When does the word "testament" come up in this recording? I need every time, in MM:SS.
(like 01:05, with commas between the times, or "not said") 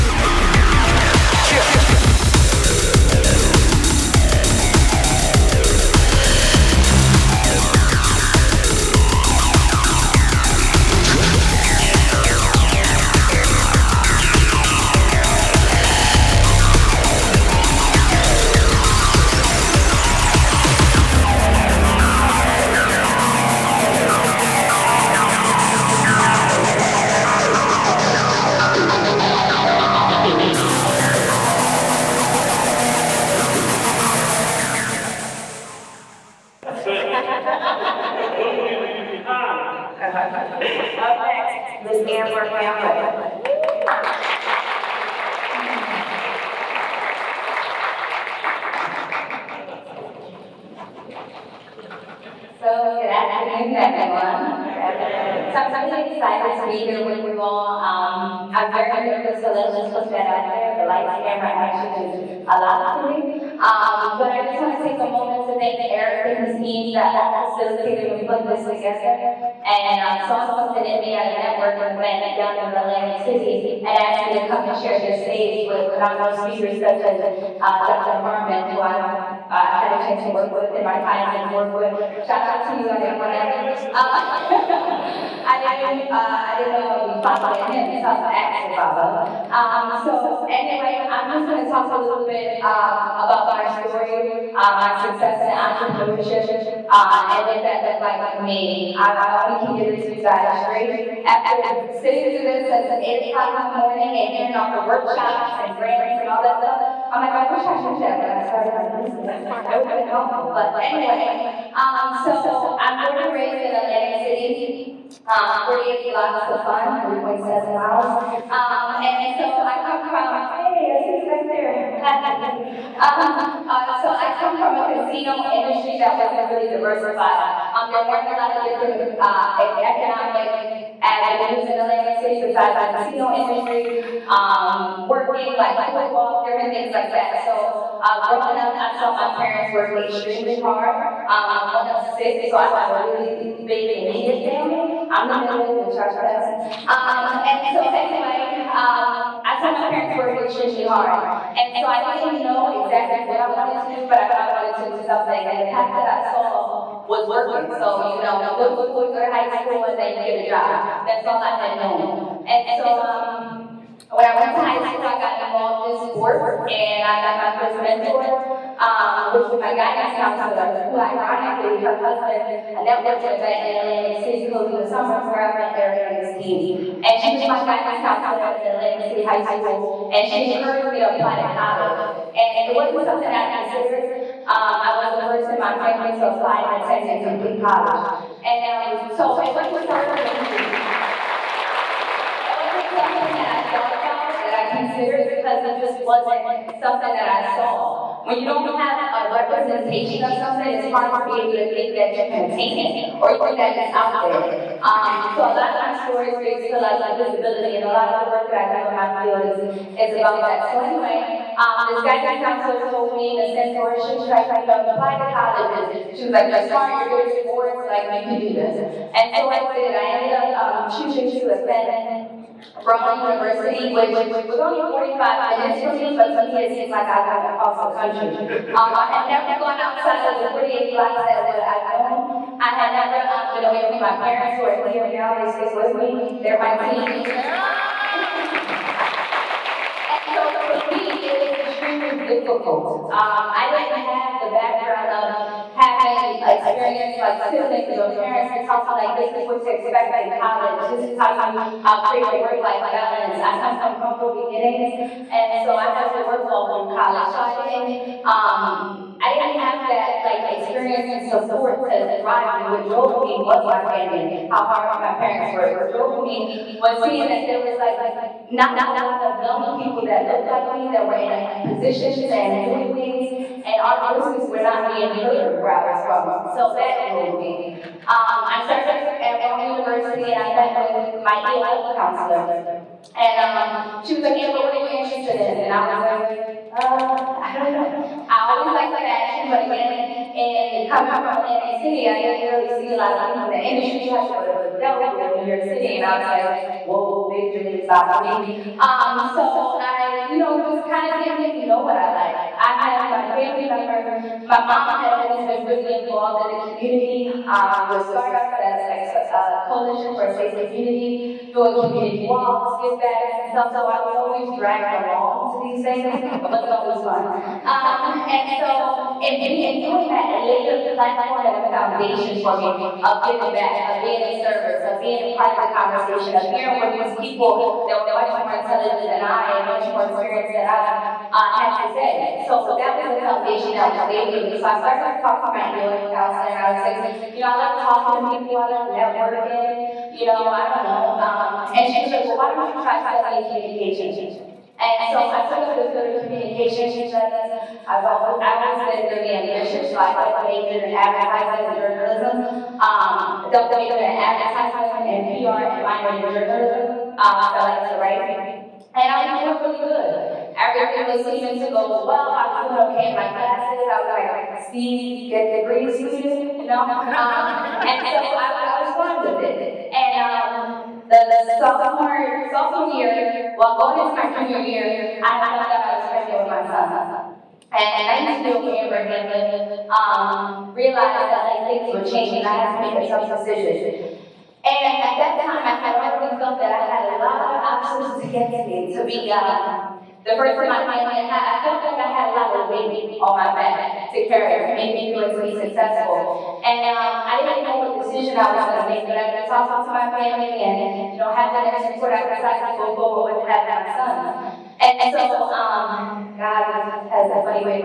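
not said.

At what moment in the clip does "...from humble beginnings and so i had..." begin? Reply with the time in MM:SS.
04:13.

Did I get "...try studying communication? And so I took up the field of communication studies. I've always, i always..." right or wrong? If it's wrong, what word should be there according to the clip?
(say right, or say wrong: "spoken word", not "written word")
right.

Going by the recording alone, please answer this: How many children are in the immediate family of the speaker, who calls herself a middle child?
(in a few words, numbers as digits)
6.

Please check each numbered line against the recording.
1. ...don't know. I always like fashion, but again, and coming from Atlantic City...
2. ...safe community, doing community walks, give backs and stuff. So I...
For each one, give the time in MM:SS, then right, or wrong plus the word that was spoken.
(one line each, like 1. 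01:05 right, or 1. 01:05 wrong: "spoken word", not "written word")
1. 04:47 right
2. 05:10 right.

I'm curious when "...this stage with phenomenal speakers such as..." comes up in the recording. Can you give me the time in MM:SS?
01:15.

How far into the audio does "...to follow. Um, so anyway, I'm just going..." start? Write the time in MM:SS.
01:28.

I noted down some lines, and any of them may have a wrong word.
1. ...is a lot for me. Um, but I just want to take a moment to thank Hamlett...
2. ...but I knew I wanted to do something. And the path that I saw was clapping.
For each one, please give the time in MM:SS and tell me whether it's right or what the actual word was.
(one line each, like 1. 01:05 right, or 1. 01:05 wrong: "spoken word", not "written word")
1. 01:01 wrong: "Eric", not "Hamlett"
2. 02:34 wrong: "working", not "clapping".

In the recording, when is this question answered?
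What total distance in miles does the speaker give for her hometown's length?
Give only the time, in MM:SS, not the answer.
01:57.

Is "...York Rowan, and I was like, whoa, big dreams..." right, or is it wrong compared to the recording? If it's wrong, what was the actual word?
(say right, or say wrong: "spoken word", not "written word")
wrong: "City", not "Rowan".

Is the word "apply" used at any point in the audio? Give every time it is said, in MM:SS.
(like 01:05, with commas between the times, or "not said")
03:01, 03:06, 03:34.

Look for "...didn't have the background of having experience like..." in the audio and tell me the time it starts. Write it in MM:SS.
04:03.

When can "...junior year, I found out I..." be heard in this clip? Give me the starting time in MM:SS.
06:14.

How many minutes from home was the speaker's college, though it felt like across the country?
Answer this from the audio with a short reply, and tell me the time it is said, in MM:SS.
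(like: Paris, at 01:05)
45, at 03:44.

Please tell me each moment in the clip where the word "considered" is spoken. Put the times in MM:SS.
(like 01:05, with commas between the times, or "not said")
03:03, 03:14.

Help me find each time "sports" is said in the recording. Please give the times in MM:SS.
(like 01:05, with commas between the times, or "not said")
02:46, 03:37.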